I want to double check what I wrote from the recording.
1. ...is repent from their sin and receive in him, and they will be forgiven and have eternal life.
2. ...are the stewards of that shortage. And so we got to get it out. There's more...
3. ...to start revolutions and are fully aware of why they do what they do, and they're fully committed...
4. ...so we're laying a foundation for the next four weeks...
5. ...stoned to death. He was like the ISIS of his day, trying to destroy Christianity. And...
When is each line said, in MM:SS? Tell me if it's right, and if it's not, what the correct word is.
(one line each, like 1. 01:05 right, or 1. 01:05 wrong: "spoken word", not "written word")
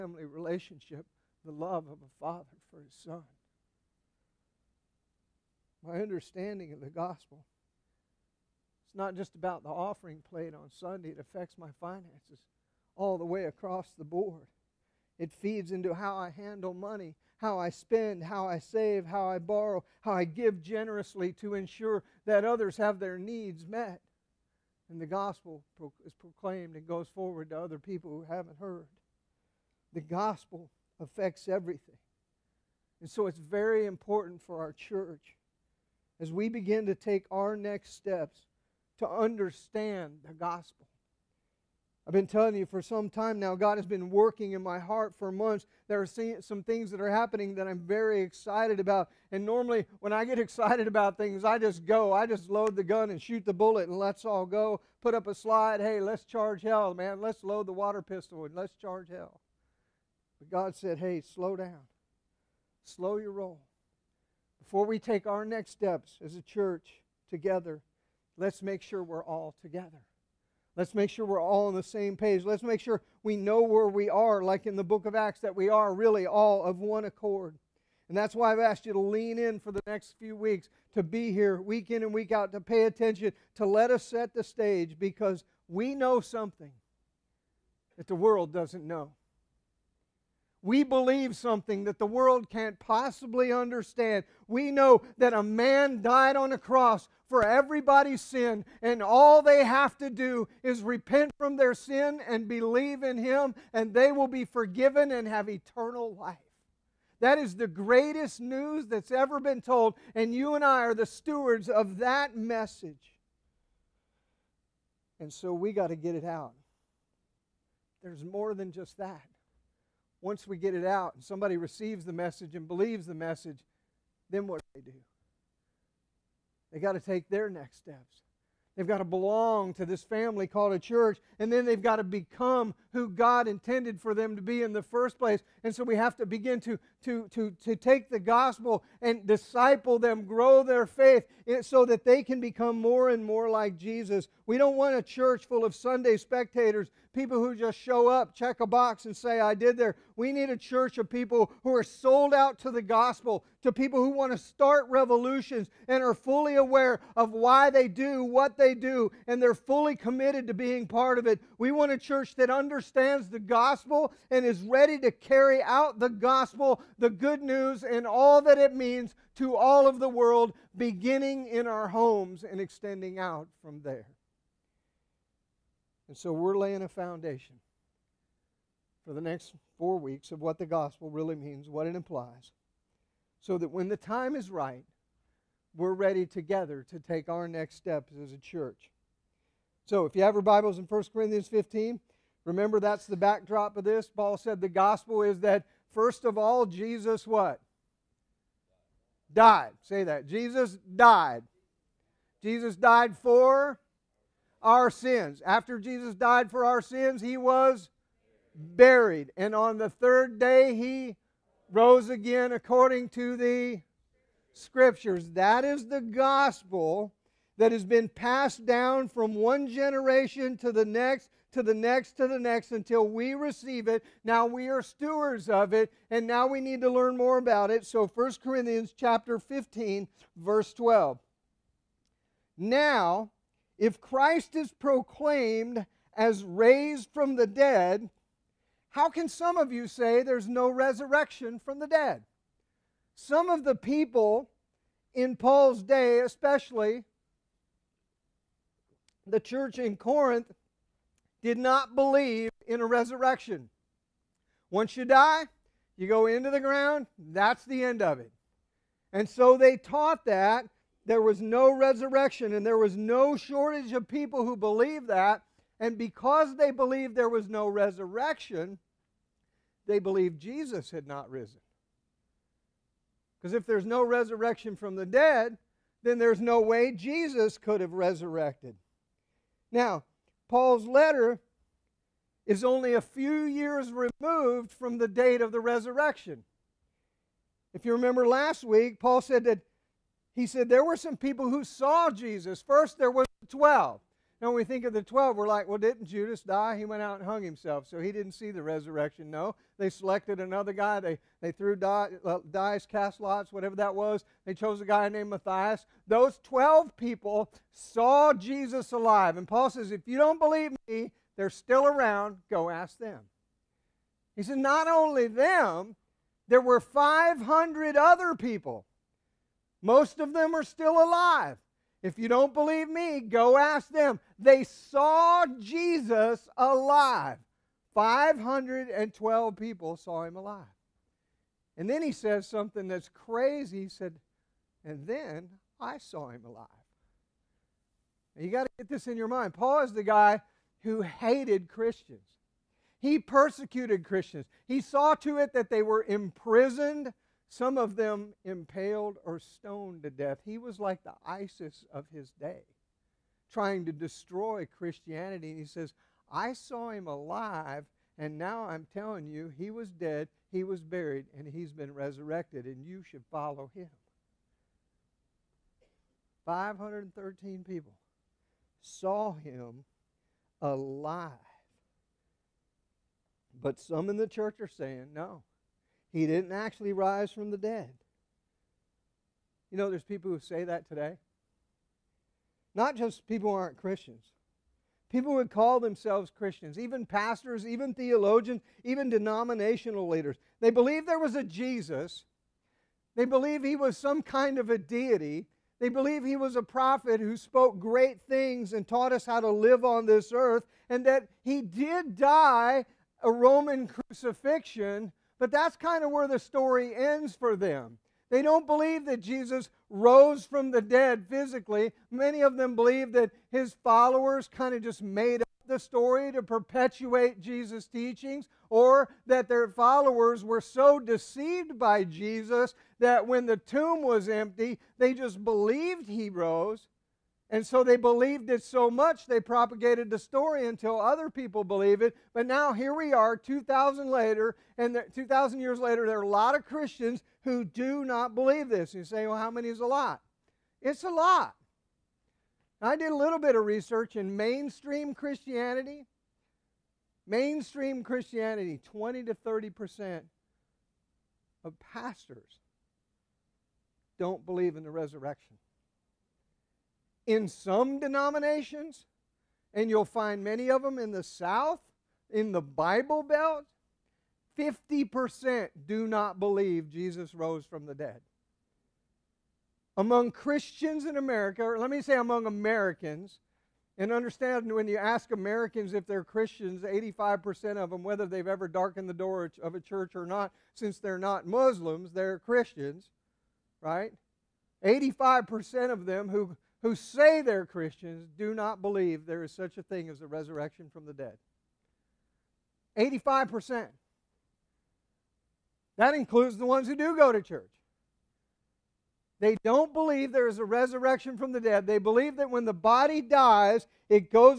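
1. 01:40 wrong: "believe", not "receive"
2. 01:50 wrong: "message", not "shortage"
3. 02:34 right
4. 02:56 right
5. 05:49 right.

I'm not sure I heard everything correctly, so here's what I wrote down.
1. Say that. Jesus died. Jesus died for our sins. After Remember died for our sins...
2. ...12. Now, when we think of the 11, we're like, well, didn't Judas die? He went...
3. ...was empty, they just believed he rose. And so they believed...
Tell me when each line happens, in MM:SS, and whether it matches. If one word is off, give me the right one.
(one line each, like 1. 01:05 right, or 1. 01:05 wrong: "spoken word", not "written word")
1. 03:19 wrong: "Jesus", not "Remember"
2. 04:53 wrong: "12", not "11"
3. 07:04 right.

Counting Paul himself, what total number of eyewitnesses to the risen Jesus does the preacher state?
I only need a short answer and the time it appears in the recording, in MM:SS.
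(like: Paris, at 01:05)
513, at 06:06.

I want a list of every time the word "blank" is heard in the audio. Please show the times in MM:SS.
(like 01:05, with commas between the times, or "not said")
not said.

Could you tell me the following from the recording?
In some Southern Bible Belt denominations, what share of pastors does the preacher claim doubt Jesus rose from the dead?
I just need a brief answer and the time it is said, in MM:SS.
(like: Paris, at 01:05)
50%, at 07:44.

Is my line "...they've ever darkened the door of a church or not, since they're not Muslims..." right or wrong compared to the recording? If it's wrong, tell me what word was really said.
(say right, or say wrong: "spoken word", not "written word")
right.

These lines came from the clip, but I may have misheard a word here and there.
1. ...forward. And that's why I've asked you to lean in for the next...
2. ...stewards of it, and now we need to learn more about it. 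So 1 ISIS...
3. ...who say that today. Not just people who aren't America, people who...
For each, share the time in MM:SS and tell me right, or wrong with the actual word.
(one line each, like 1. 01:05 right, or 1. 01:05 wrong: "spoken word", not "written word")
1. 01:17 wrong: "accord", not "forward"
2. 03:44 wrong: "Corinthians", not "ISIS"
3. 06:20 wrong: "Christians", not "America".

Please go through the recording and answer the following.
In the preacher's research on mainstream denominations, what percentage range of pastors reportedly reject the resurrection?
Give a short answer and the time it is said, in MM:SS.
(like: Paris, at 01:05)
20 to 30%, at 07:28.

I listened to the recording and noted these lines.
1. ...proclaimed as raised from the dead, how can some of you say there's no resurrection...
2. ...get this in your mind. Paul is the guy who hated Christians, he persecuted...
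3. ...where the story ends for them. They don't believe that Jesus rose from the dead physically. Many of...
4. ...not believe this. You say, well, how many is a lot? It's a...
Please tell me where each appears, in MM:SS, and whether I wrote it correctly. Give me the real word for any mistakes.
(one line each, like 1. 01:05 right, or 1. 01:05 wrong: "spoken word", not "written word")
1. 03:54 right
2. 05:38 right
3. 06:46 right
4. 07:18 right.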